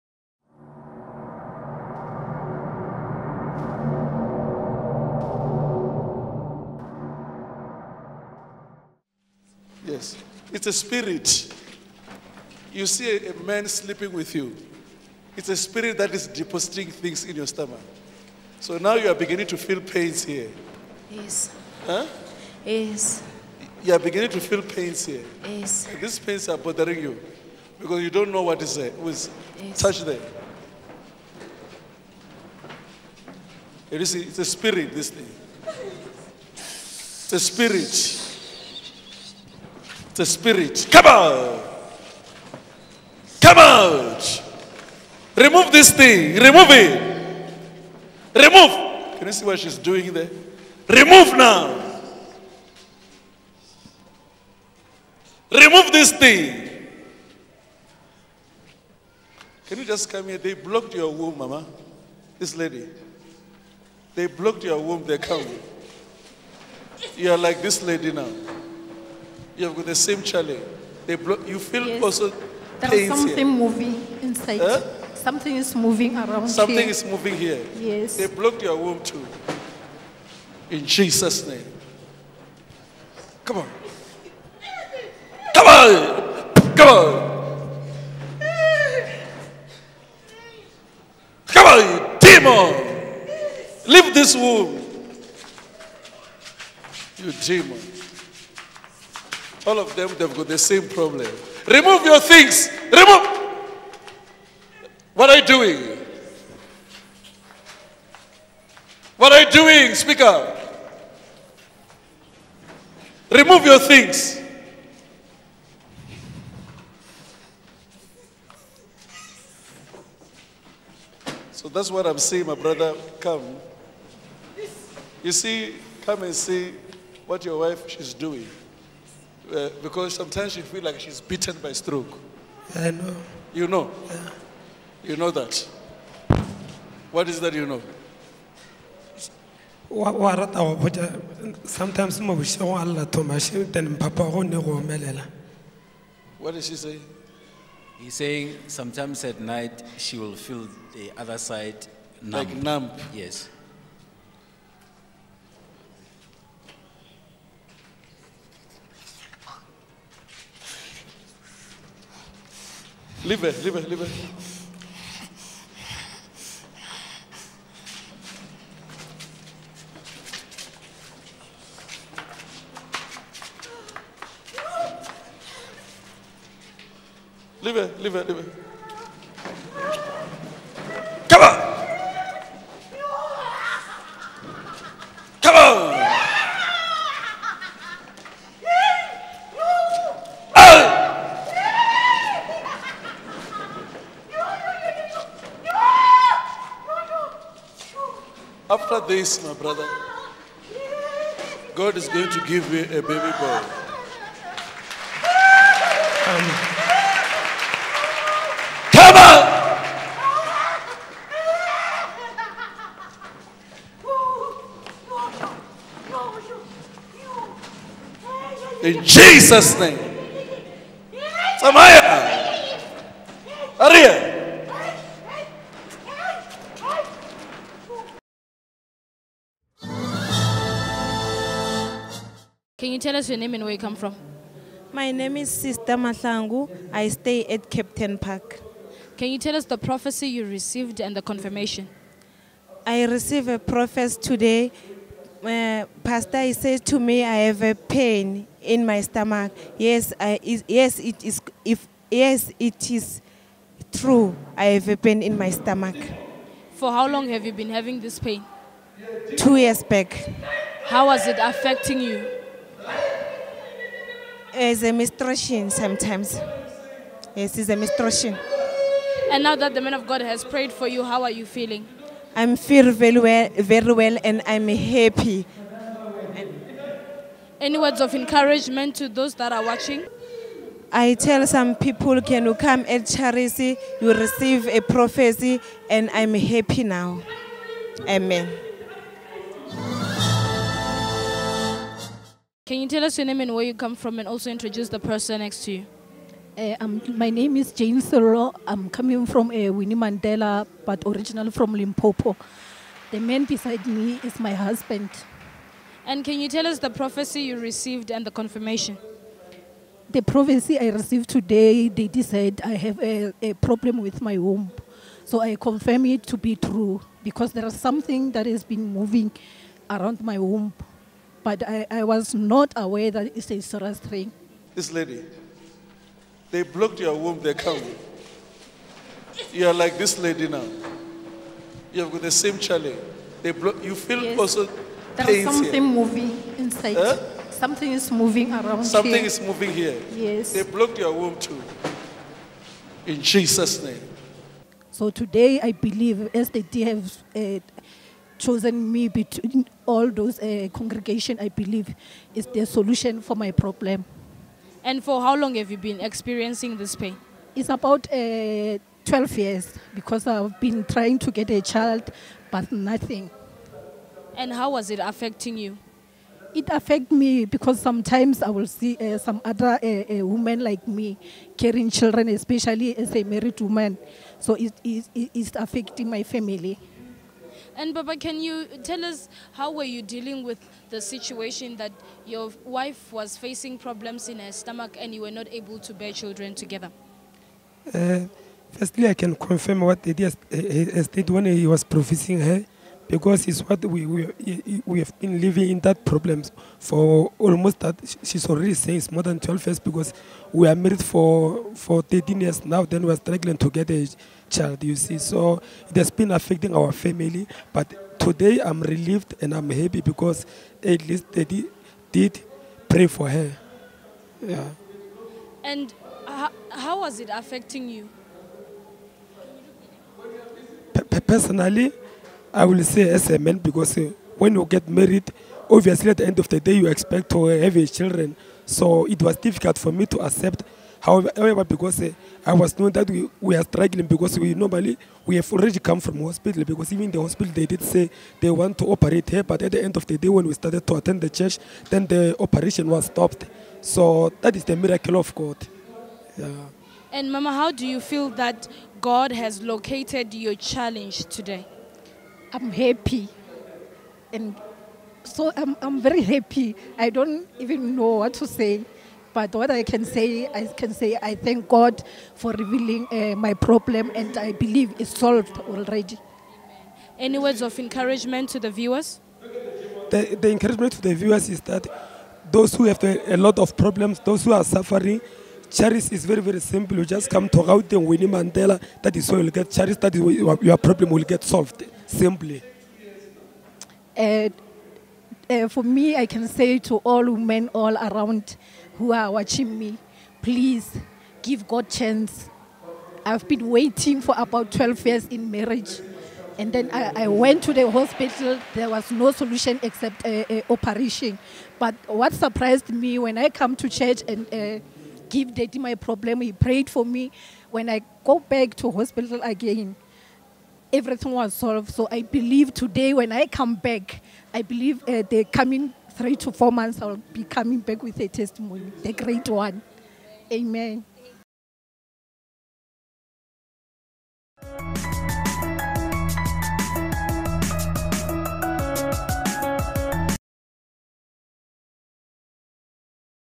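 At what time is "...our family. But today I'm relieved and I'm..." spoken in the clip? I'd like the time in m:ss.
6:46.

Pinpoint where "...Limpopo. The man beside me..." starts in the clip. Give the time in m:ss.
5:01.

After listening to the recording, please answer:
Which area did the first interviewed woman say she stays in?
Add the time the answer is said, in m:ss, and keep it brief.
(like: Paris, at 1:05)
Kempton Park, at 3:57.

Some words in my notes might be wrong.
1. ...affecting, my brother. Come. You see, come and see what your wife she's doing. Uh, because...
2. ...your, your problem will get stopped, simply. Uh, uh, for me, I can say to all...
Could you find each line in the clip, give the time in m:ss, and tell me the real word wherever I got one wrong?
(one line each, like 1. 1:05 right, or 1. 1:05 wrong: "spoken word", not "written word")
1. 2:02 wrong: "saying", not "affecting"
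2. 8:00 wrong: "solved", not "stopped".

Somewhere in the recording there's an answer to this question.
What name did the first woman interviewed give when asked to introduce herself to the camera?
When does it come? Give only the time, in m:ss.
3:55.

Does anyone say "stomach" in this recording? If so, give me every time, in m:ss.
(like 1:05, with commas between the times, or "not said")
0:17, 4:09, 4:15, 6:24.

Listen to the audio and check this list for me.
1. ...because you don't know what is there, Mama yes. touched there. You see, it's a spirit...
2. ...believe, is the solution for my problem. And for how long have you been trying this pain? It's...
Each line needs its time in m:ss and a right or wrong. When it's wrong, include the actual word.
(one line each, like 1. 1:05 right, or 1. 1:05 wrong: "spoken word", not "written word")
1. 0:27 wrong: "Was", not "Mama"
2. 5:51 wrong: "experiencing", not "trying".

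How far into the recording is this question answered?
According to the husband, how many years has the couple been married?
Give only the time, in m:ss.
6:42.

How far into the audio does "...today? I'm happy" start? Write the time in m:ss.
7:31.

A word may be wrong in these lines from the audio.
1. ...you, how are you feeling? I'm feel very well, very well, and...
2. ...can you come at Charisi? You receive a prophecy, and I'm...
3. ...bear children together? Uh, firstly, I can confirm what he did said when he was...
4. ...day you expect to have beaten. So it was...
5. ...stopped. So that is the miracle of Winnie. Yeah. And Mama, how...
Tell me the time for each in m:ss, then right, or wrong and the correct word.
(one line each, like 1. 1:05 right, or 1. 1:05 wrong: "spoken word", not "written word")
1. 4:30 right
2. 4:42 right
3. 6:25 right
4. 7:06 wrong: "children", not "beaten"
5. 7:23 wrong: "God", not "Winnie".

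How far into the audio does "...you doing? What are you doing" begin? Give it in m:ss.
1:45.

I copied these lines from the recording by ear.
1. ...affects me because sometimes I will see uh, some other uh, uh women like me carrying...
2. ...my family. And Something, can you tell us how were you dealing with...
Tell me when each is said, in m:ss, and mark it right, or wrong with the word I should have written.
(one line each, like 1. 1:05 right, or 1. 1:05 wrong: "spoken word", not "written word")
1. 6:06 right
2. 6:16 wrong: "Baba", not "Something".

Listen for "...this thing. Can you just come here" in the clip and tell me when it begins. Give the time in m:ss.
0:55.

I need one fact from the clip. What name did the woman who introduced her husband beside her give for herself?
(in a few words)
Jane Cyril.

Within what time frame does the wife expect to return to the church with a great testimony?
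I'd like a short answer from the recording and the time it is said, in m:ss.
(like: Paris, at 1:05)
3 to 4 months, at 8:36.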